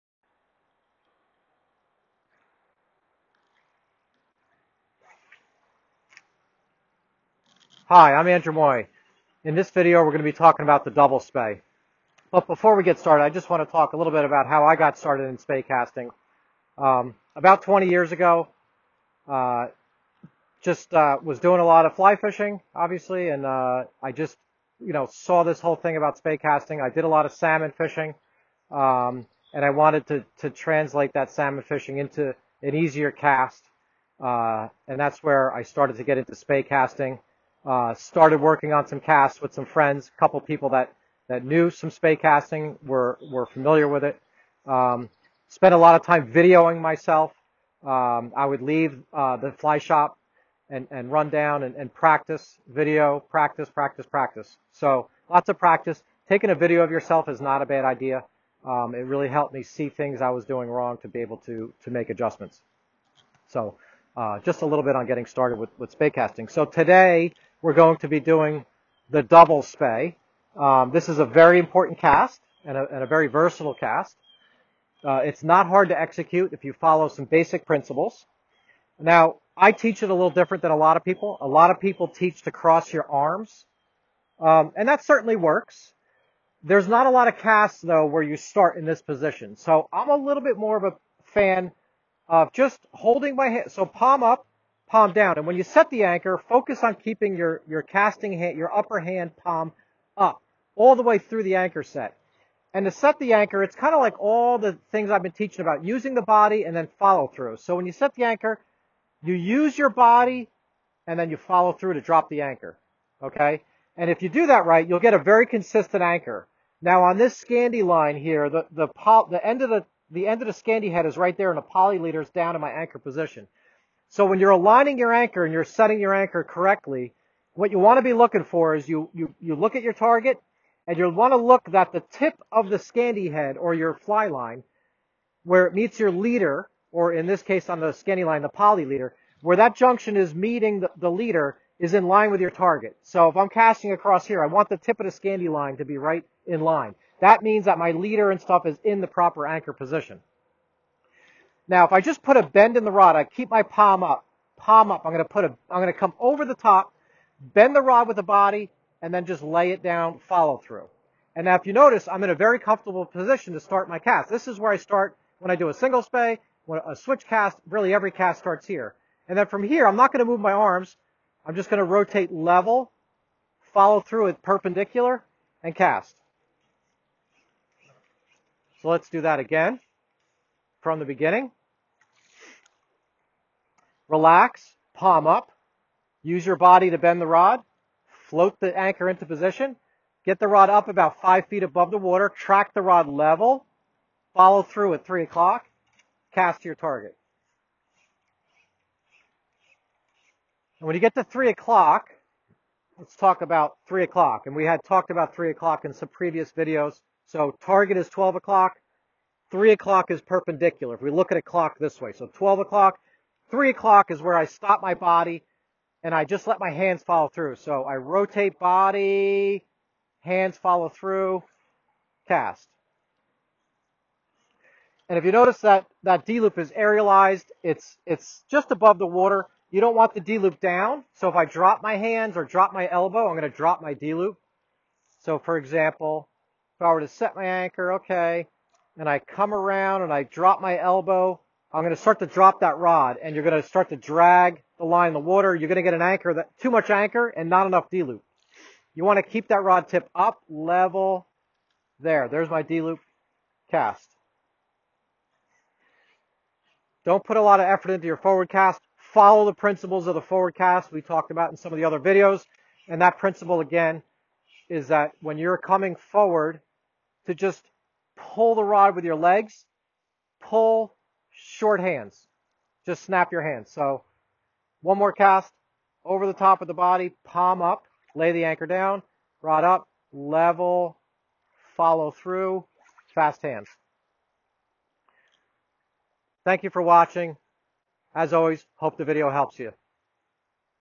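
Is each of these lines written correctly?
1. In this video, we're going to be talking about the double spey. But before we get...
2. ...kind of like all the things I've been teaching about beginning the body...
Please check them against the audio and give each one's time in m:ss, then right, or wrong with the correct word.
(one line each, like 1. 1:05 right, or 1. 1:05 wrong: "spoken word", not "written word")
1. 0:09 right
2. 1:43 wrong: "using", not "beginning".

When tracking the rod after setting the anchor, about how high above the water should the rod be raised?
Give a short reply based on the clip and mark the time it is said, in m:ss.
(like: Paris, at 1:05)
5 feet, at 3:11.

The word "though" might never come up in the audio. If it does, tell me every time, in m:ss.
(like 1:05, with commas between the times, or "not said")
1:27.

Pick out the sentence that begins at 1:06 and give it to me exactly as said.
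So today we're going to be doing the double spey.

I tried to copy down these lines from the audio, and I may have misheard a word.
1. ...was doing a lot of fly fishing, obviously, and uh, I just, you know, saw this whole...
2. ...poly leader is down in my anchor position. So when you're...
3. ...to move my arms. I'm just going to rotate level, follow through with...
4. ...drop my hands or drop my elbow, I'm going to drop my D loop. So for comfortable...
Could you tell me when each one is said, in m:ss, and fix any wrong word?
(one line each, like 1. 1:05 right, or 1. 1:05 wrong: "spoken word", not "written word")
1. 0:21 right
2. 2:01 right
3. 2:50 right
4. 3:51 wrong: "example", not "comfortable".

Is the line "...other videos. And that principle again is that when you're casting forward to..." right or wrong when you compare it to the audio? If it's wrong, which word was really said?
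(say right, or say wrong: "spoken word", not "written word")
wrong: "coming", not "casting".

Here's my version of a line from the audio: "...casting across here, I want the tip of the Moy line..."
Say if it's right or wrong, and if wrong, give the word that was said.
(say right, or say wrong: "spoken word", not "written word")
wrong: "Scandi", not "Moy".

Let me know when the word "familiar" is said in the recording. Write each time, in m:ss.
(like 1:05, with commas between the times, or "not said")
0:43.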